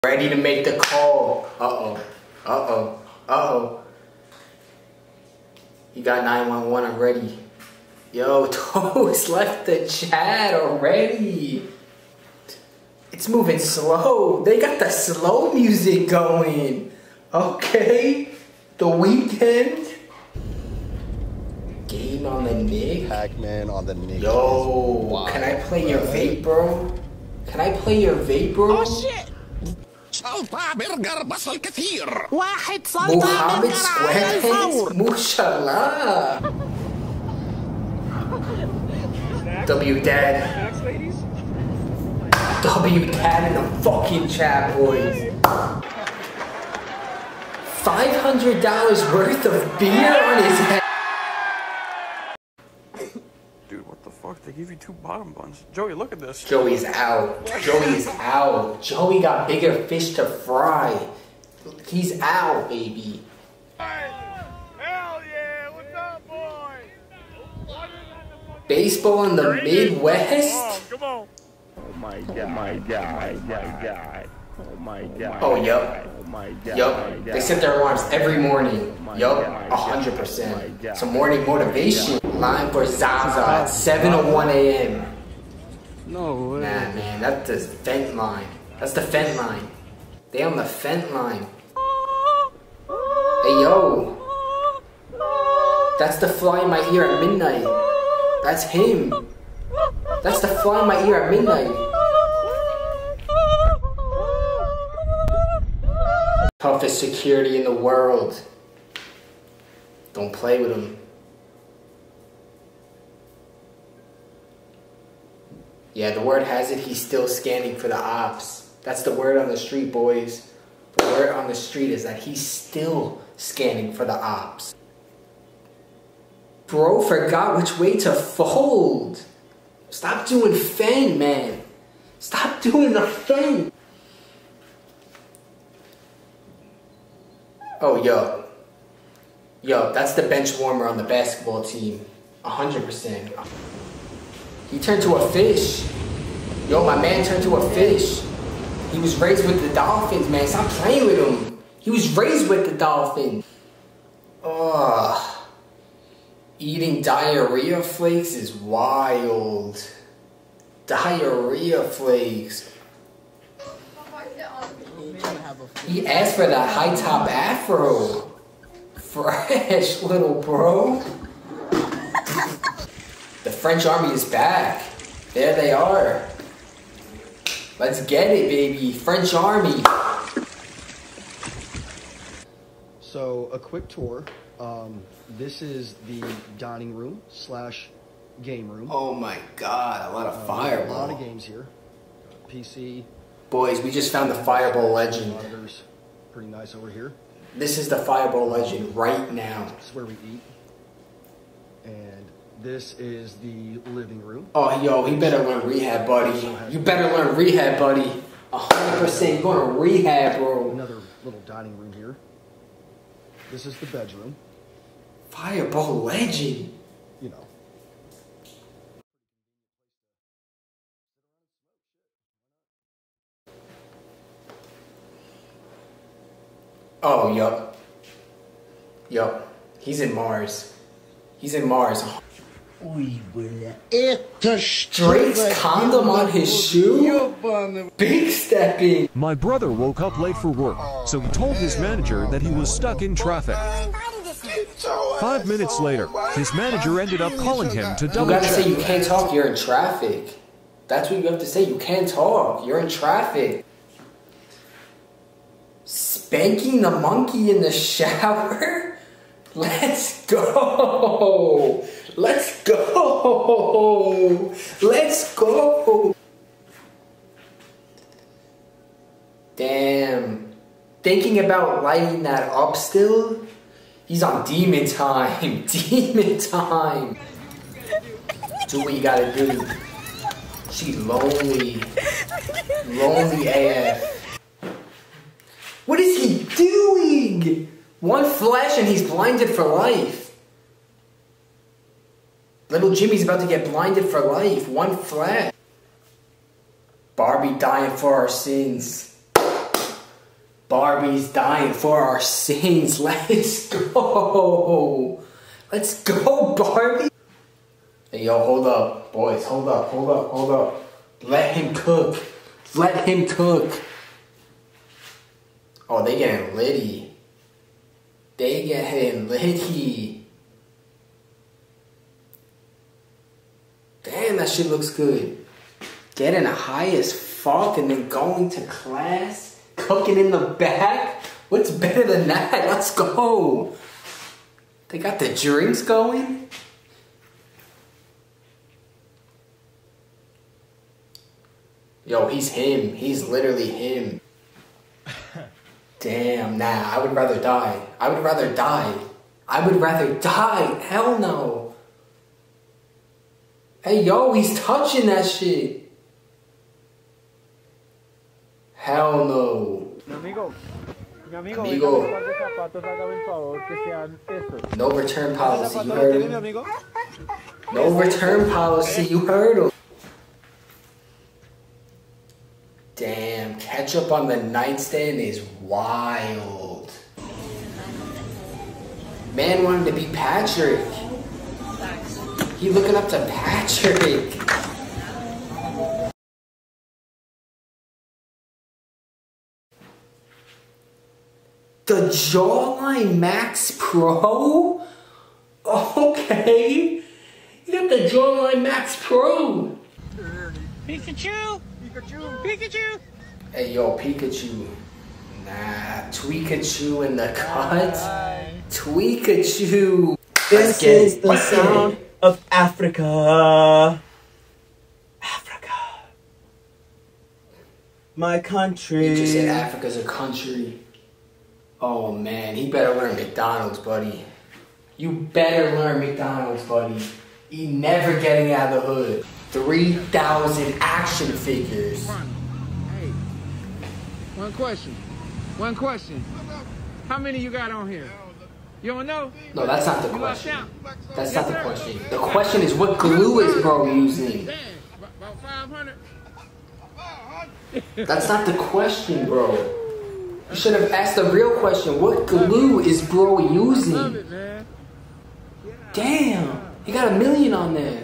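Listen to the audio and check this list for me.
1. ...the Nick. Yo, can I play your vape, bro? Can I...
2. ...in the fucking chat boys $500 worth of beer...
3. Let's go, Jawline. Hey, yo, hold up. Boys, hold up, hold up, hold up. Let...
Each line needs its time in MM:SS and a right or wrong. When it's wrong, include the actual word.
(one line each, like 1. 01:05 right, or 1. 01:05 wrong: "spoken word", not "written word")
1. 00:23 right
2. 00:43 right
3. 05:05 wrong: "Barbie", not "Jawline".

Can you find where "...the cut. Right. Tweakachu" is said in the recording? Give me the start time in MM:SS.
06:47.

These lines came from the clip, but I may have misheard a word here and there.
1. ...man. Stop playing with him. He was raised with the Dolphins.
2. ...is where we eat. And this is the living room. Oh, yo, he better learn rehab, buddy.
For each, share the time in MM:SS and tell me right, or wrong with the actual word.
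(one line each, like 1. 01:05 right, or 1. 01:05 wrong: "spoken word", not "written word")
1. 02:30 right
2. 03:19 right.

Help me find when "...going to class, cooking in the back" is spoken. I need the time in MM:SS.
05:28.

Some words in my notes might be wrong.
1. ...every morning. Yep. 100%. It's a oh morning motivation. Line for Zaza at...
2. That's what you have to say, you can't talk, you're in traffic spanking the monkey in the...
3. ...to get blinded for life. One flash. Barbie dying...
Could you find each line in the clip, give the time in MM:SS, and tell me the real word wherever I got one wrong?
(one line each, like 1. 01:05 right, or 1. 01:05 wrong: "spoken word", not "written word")
1. 01:18 right
2. 04:10 right
3. 04:53 right.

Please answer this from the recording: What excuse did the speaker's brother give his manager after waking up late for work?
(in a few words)
Stuck in traffic.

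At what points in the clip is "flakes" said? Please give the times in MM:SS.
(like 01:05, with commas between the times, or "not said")
02:37, 02:41.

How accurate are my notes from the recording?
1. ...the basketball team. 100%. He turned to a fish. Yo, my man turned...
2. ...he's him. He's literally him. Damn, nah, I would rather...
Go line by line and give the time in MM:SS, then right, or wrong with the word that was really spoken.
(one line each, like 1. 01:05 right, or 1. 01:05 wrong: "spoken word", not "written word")
1. 02:20 right
2. 05:42 right.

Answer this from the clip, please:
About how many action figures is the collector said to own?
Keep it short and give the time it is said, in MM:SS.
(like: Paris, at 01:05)
3,000, at 07:09.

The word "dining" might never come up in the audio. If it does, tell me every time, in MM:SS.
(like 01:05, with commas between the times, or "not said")
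03:06, 03:31.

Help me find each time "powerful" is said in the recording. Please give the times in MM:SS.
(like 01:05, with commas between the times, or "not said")
not said.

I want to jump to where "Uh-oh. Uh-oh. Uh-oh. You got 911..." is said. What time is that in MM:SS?
00:01.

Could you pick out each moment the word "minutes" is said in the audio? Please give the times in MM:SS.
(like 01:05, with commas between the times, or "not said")
04:05.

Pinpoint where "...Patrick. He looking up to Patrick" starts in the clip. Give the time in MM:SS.
06:20.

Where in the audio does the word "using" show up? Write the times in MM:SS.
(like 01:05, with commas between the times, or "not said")
07:23, 07:33.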